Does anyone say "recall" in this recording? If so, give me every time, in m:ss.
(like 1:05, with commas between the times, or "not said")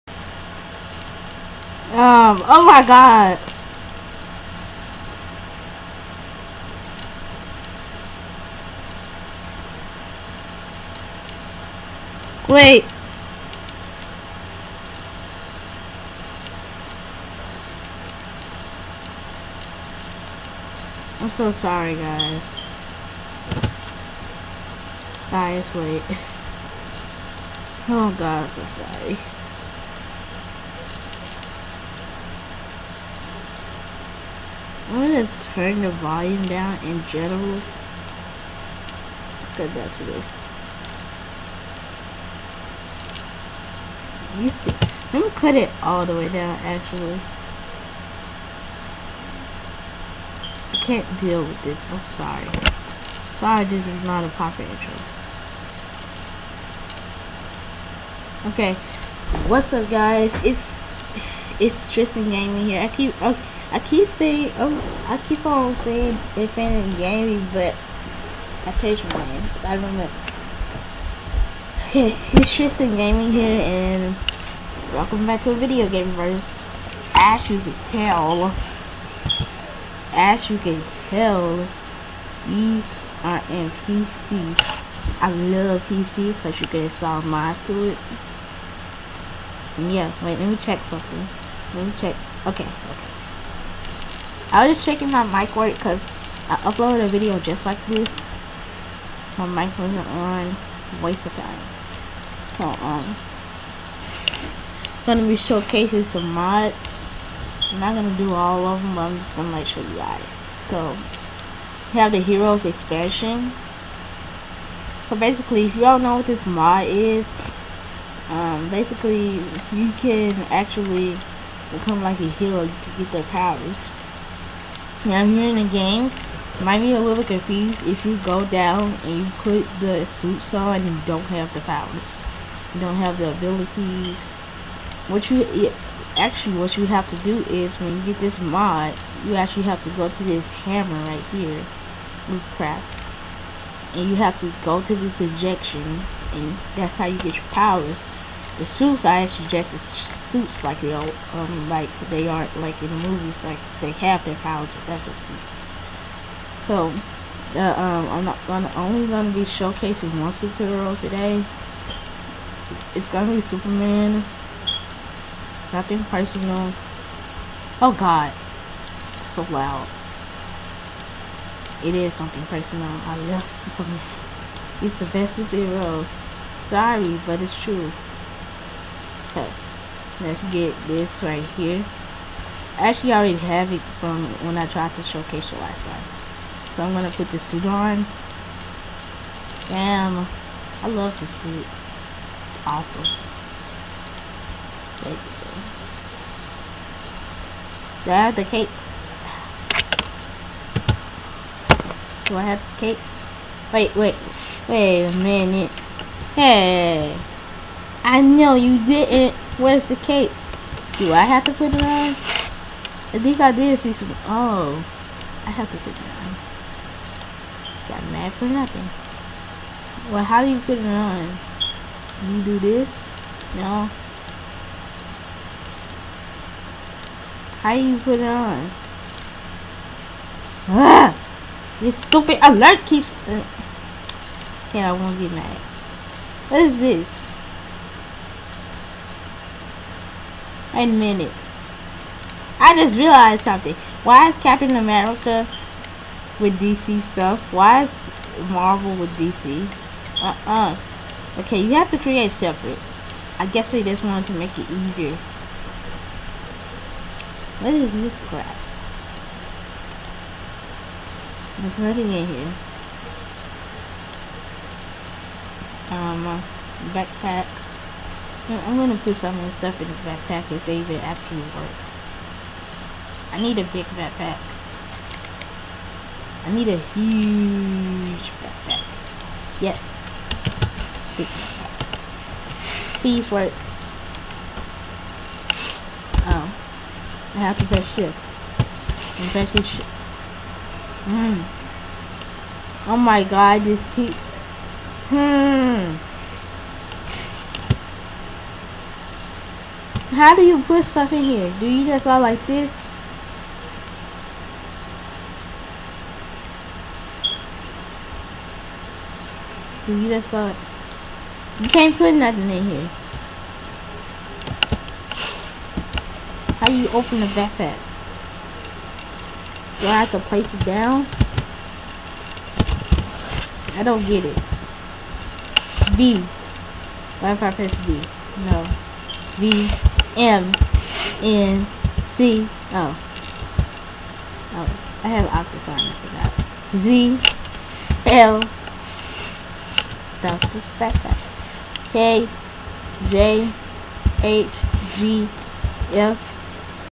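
not said.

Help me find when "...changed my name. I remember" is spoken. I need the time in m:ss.
1:08.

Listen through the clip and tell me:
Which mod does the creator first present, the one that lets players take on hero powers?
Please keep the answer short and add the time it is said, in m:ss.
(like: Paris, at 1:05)
Heroes expansion, at 1:52.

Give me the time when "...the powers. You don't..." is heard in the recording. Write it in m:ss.
2:11.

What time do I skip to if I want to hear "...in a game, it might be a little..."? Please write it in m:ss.
2:05.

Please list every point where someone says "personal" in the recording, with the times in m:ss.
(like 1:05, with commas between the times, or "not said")
2:46, 2:52.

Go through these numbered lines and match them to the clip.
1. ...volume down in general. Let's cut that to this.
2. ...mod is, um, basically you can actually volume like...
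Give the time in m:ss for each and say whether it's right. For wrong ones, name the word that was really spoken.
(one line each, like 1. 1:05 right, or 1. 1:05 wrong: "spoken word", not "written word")
1. 0:35 right
2. 1:56 wrong: "become", not "volume".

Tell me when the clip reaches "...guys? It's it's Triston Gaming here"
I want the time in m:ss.
0:59.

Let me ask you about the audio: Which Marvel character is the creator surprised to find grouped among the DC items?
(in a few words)
Captain America.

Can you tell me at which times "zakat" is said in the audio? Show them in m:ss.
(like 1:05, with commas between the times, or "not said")
not said.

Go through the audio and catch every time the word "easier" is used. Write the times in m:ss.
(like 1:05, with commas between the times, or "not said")
4:14.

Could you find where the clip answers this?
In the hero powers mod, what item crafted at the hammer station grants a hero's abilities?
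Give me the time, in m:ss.
2:25.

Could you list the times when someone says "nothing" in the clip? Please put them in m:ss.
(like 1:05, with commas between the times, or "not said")
2:45, 3:38, 4:21, 5:12.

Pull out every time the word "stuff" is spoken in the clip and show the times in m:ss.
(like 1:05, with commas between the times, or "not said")
4:07, 4:29, 5:00.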